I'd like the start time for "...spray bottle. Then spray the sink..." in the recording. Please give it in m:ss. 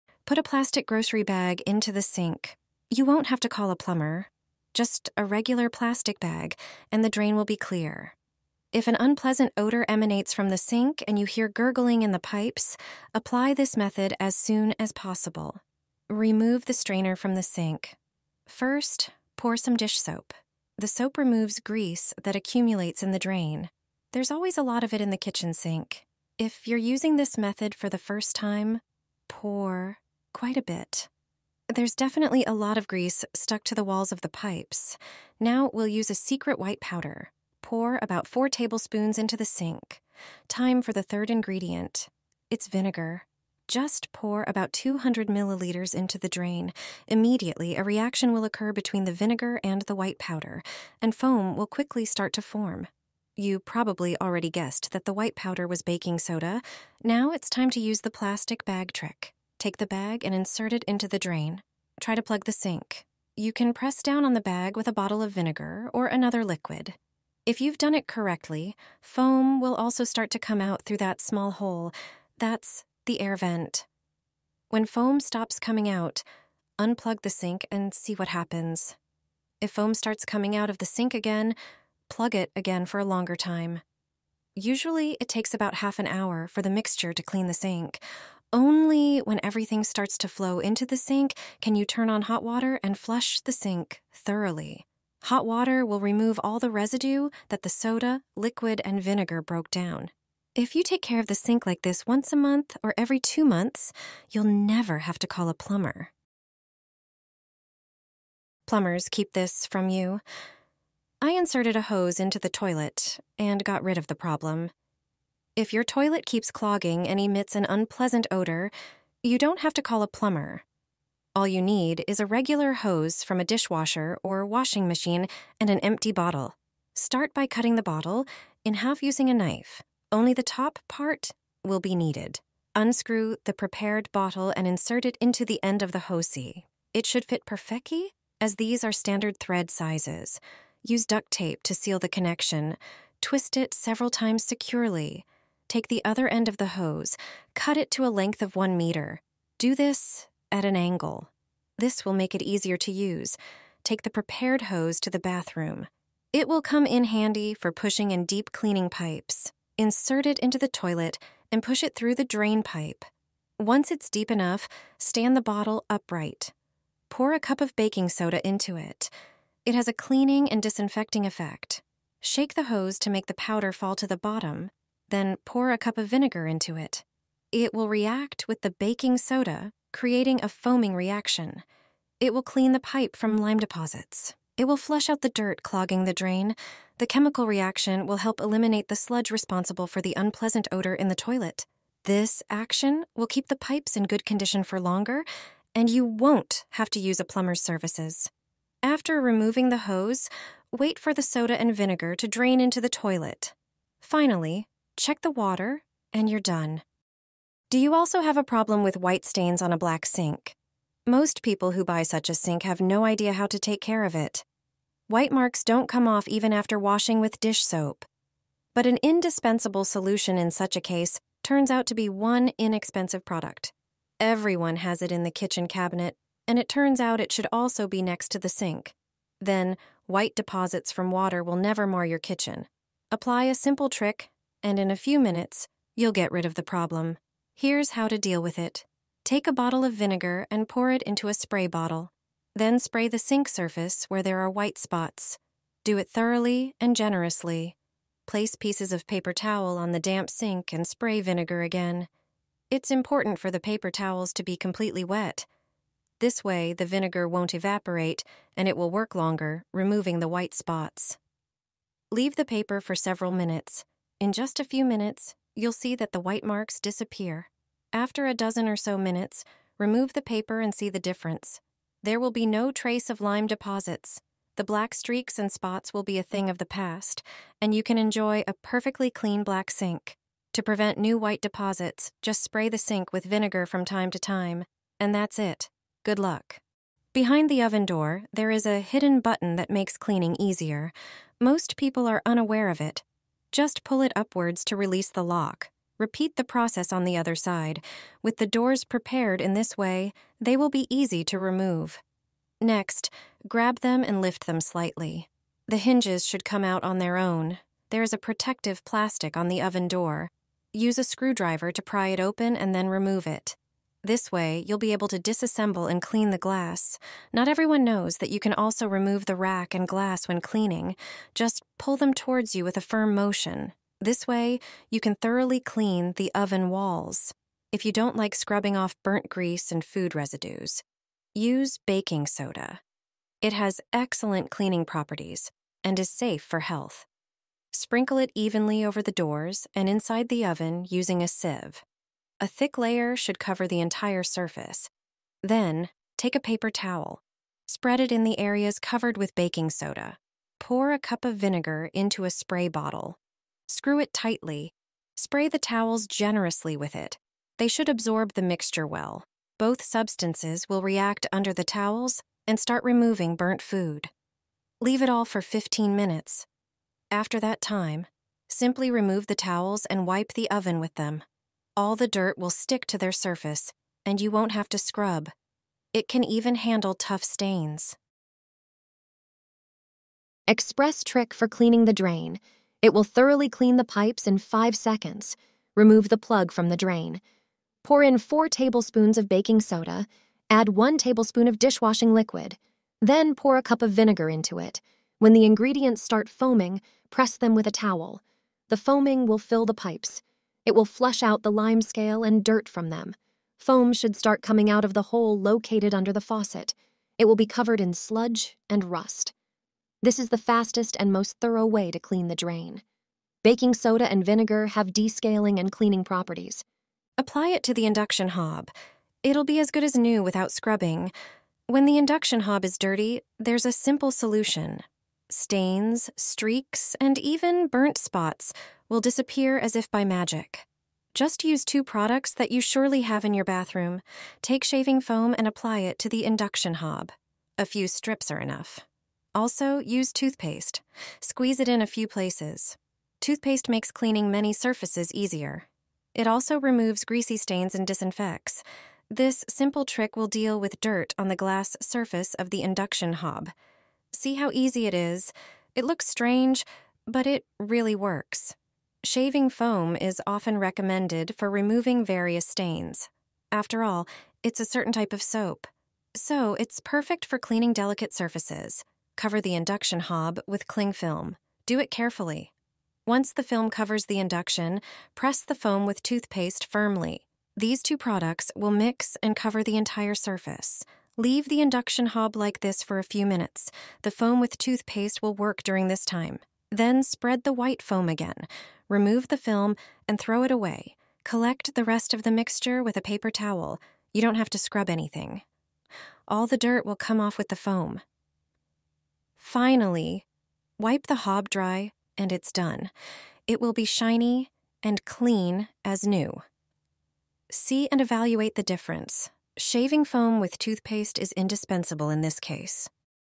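4:01.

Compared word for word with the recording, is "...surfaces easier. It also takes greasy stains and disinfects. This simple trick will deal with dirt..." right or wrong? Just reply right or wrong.
wrong.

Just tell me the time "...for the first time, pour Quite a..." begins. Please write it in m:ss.
0:27.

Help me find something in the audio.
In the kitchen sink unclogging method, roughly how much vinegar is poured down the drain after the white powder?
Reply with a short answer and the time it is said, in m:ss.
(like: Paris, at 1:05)
200 milliliters, at 0:44.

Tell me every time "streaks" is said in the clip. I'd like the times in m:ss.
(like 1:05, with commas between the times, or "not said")
4:34, 7:06.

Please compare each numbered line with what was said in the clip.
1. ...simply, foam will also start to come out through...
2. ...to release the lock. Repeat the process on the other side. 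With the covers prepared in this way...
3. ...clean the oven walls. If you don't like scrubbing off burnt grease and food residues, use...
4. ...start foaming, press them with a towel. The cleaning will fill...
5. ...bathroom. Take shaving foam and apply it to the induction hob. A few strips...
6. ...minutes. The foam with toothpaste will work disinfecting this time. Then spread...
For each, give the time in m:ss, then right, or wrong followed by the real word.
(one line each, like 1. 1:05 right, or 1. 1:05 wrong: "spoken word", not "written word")
1. 1:08 wrong: "correctly", not "simply"
2. 4:54 wrong: "doors", not "covers"
3. 5:25 right
4. 6:36 wrong: "foaming", not "cleaning"
5. 7:13 right
6. 8:03 wrong: "during", not "disinfecting".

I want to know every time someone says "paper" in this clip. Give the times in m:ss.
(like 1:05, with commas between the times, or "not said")
4:09, 4:13, 4:22, 4:30, 5:46, 8:13.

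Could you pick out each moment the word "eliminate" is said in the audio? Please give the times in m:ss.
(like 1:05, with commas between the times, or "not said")
3:08.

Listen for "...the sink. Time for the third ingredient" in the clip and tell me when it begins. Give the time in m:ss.
0:39.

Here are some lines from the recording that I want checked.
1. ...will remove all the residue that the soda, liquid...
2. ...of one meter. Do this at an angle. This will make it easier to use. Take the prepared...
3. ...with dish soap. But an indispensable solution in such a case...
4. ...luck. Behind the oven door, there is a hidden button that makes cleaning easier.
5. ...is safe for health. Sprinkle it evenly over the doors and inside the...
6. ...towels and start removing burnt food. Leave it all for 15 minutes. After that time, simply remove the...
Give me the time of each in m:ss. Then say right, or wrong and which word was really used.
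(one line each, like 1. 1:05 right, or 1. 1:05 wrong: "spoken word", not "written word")
1. 1:35 right
2. 2:28 right
3. 3:37 right
4. 4:46 right
5. 5:35 right
6. 6:01 right.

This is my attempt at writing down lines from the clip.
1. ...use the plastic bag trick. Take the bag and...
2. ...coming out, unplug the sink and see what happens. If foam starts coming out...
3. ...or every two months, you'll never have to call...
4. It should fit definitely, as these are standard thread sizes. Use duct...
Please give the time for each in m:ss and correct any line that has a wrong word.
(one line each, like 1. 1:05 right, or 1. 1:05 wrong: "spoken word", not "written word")
1. 0:57 right
2. 1:15 right
3. 1:42 right
4. 2:16 wrong: "perfectly", not "definitely".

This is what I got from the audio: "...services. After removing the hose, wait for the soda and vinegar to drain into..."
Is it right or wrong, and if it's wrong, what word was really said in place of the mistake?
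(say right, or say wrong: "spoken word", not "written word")
right.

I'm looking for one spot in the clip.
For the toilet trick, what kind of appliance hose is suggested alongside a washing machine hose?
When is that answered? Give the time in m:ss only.
2:03.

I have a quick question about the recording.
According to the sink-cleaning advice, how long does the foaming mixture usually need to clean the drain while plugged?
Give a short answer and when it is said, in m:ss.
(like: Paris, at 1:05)
half an hour, at 1:25.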